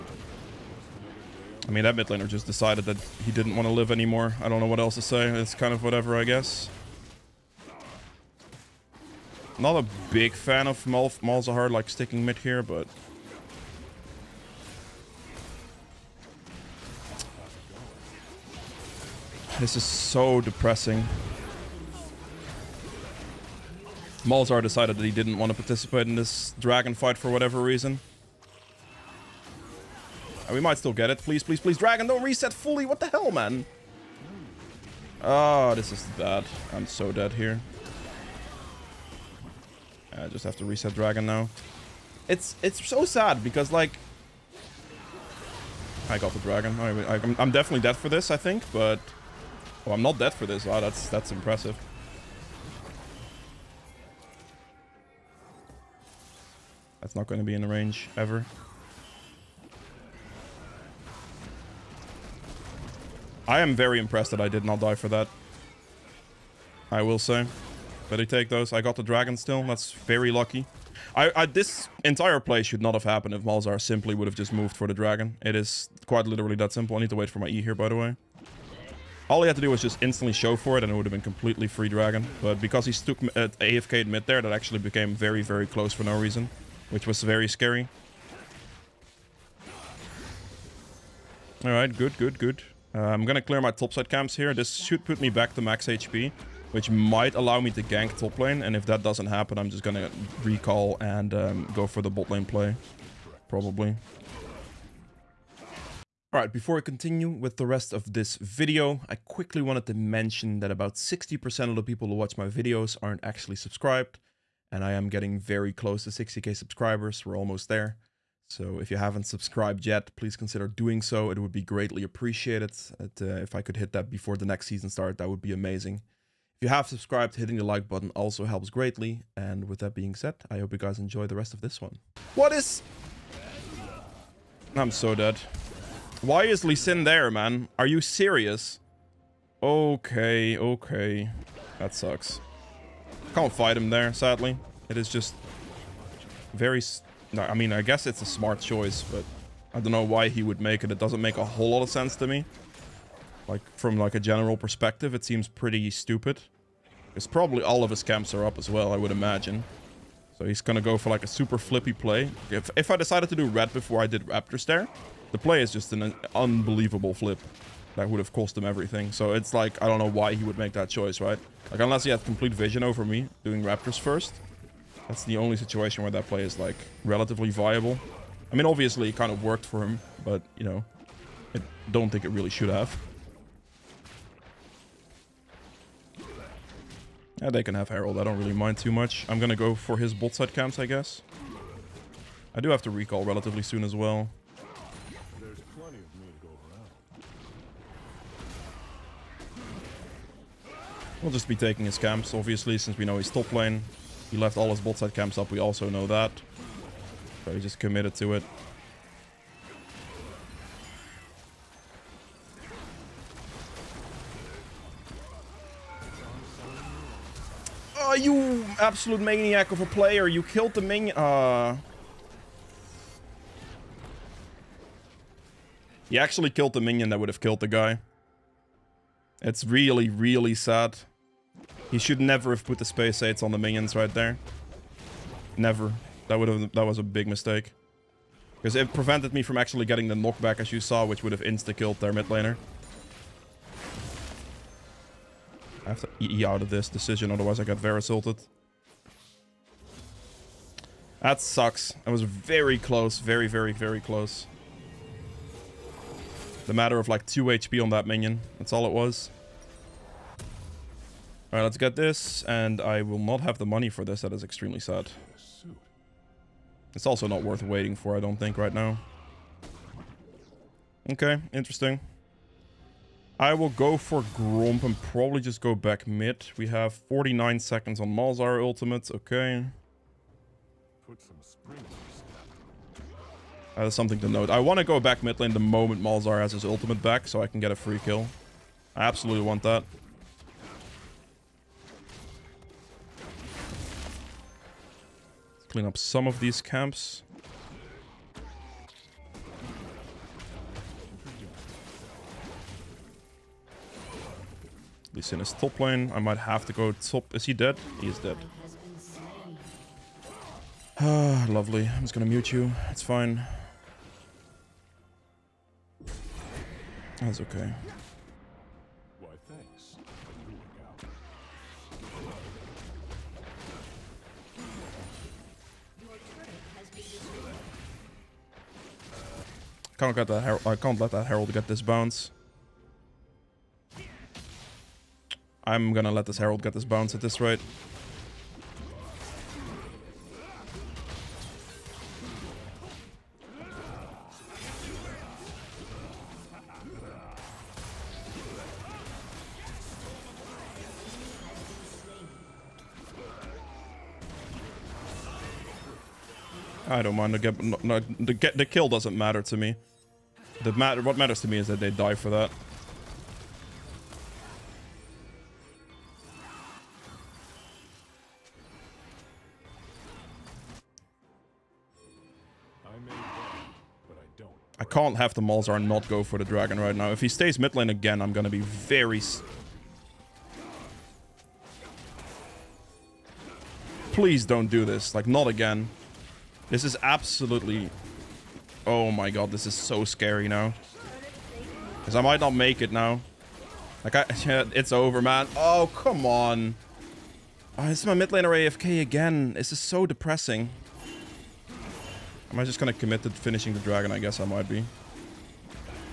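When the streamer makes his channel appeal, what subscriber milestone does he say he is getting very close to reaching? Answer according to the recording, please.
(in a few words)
60k.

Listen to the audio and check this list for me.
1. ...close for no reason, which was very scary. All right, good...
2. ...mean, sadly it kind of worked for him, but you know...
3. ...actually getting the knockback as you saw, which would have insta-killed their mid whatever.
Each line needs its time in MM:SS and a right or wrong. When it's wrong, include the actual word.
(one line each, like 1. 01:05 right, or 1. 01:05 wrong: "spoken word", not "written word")
1. 01:25 right
2. 02:58 wrong: "obviously", not "sadly"
3. 03:59 wrong: "laner", not "whatever".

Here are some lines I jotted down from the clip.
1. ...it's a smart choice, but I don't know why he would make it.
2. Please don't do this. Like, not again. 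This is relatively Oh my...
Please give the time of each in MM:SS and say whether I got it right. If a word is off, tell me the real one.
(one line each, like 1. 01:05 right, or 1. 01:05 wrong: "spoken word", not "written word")
1. 02:28 right
2. 06:24 wrong: "absolutely", not "relatively".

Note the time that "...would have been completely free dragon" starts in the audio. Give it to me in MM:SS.
01:20.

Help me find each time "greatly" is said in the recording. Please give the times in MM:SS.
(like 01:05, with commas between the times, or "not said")
02:01, 02:08.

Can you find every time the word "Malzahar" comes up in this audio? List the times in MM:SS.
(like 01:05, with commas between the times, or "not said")
00:11, 00:24, 01:13, 04:38, 04:46, 06:15.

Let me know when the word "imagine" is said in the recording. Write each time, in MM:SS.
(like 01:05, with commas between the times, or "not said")
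02:39.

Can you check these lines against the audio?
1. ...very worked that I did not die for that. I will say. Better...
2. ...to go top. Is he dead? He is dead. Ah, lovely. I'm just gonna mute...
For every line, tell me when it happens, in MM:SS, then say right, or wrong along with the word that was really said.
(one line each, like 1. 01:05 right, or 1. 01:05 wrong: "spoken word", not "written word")
1. 01:03 wrong: "impressed", not "worked"
2. 05:06 right.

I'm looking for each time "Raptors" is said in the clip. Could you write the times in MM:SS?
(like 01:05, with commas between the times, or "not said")
02:44, 02:53.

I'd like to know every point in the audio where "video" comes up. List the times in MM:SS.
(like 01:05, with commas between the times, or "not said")
01:48, 01:52.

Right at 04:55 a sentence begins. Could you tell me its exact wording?
Clean up some of these camps.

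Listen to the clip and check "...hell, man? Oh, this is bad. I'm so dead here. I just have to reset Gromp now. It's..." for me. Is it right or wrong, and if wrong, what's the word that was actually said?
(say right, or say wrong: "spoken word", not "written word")
wrong: "Dragon", not "Gromp".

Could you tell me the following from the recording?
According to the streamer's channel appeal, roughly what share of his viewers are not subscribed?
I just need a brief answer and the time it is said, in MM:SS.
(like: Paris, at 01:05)
60%, at 01:50.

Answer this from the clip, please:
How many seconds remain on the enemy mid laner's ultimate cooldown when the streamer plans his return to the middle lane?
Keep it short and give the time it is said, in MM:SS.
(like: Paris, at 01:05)
49, at 04:36.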